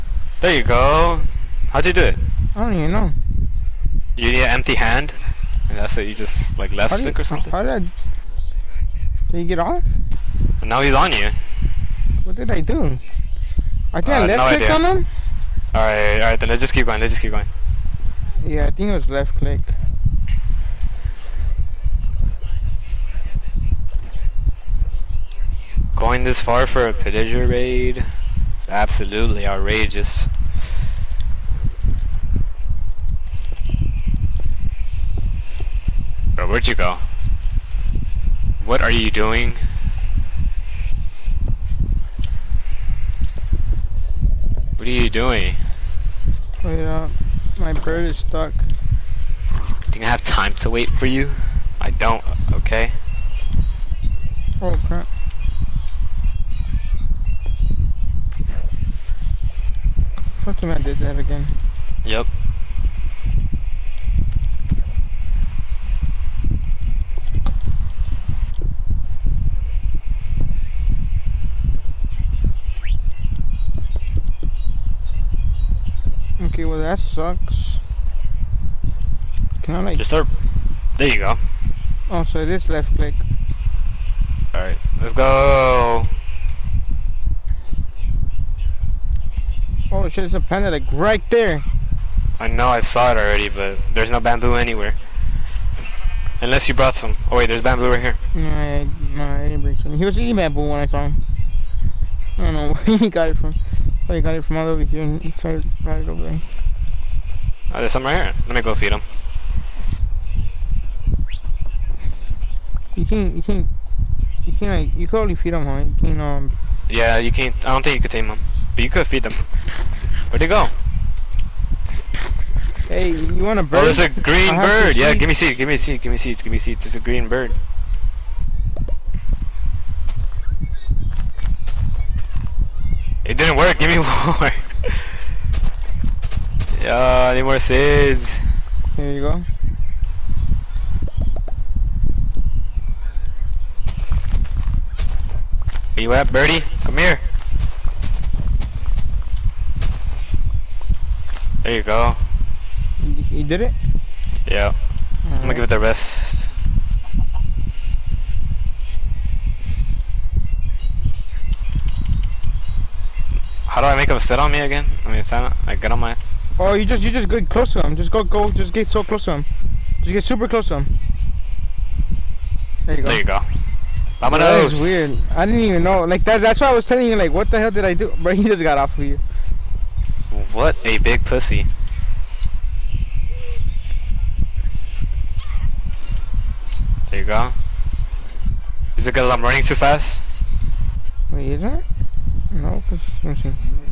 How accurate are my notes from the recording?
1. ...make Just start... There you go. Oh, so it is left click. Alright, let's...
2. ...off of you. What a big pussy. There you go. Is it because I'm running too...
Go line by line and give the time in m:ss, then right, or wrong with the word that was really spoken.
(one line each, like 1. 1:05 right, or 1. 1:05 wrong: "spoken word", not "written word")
1. 1:19 right
2. 2:58 right.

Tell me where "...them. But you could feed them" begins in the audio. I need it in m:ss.
1:58.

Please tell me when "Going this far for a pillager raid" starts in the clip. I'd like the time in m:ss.
0:25.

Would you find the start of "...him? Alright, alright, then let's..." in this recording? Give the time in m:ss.
0:14.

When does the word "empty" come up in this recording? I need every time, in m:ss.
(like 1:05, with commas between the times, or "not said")
0:04.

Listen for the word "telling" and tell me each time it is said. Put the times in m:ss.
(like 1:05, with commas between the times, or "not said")
2:56.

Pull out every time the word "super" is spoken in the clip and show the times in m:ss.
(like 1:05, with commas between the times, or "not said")
2:50.